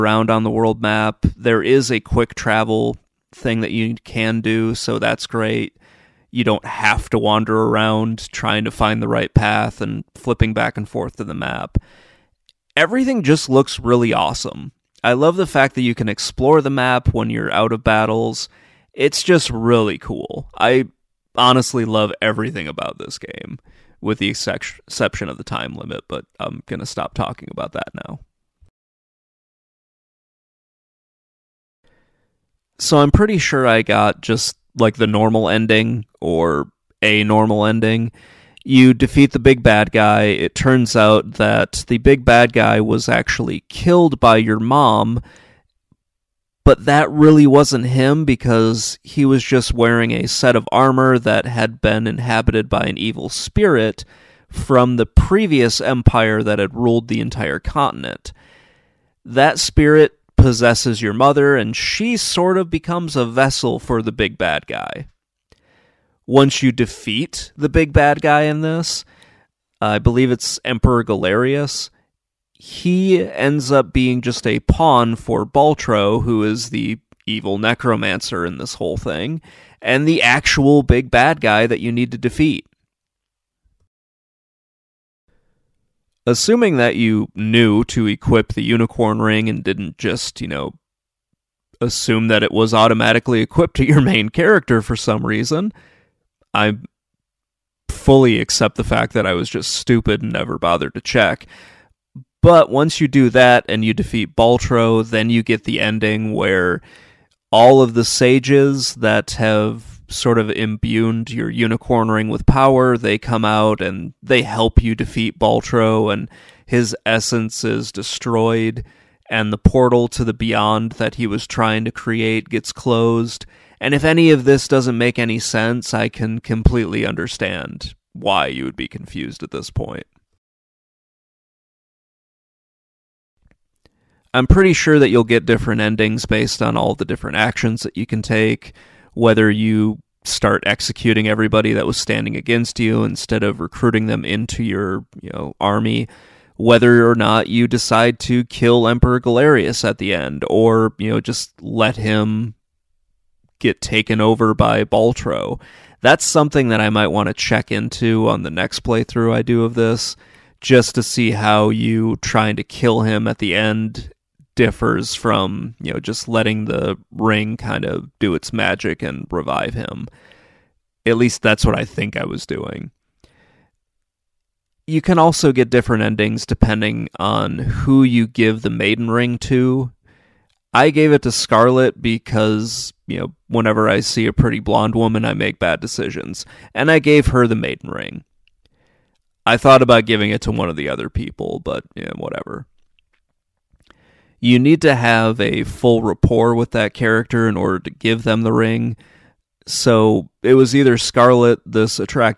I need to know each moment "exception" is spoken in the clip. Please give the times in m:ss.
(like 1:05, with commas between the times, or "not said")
0:24.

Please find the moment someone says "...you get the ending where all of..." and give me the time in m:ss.
1:45.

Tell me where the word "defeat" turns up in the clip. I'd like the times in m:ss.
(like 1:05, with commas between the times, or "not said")
0:38, 1:06, 1:22, 1:43, 1:54.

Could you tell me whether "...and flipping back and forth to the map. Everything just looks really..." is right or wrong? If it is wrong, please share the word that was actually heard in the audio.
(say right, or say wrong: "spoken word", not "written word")
right.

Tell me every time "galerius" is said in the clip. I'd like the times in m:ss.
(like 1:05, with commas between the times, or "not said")
1:11, 2:29.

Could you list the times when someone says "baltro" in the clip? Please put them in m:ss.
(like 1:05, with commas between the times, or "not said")
1:15, 1:44, 1:55, 2:34.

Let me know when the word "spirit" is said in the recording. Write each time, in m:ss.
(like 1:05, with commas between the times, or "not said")
0:53, 0:59.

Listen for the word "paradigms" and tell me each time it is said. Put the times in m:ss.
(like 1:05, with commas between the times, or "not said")
not said.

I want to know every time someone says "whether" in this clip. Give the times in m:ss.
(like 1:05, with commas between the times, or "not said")
2:19, 2:26.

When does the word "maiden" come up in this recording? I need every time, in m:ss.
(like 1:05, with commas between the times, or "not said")
2:58, 3:07.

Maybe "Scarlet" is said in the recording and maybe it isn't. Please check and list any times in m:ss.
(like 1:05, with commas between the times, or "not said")
3:01, 3:20.